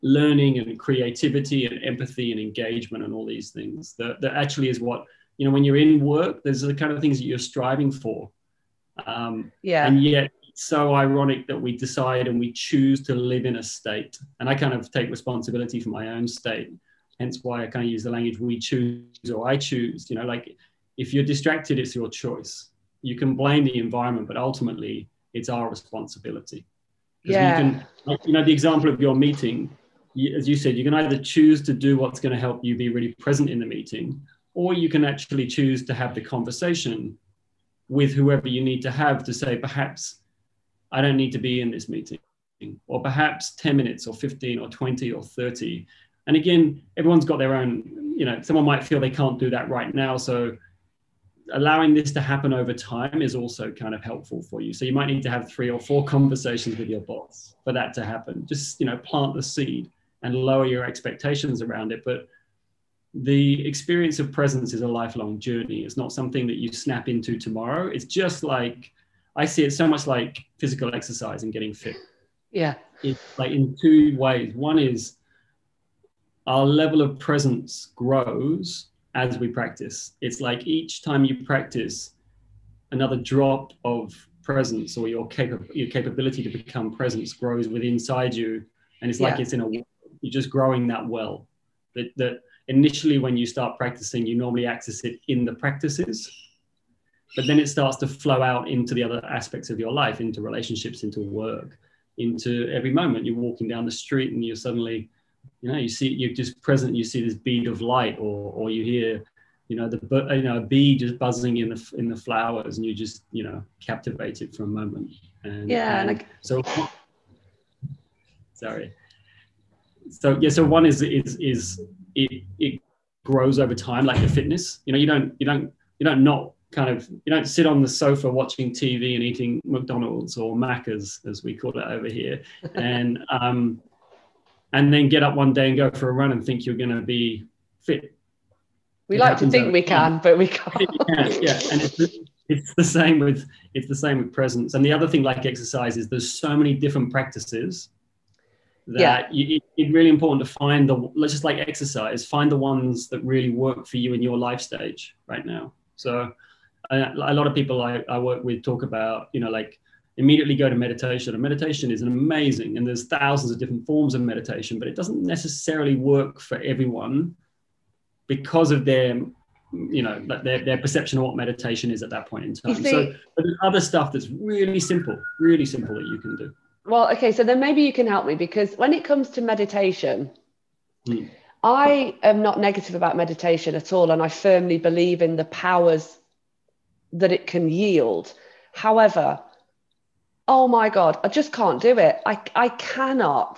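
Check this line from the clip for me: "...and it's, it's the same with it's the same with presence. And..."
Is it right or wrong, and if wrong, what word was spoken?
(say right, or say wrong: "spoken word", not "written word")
right.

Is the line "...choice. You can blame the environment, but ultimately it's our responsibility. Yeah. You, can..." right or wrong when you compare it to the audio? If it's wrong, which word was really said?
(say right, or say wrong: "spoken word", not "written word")
right.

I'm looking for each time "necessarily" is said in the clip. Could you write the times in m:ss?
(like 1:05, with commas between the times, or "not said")
2:45.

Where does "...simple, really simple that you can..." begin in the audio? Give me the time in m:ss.
2:54.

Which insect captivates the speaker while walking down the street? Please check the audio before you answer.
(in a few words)
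bee.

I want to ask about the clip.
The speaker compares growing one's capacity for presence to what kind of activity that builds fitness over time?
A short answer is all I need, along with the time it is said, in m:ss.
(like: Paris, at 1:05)
physical exercise, at 1:10.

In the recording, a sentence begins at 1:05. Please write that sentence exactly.
It's not something that you snap into tomorrow.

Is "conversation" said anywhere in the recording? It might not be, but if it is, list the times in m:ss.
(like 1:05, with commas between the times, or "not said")
0:36, 0:56.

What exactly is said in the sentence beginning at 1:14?
One is our level of presence grows as we practice.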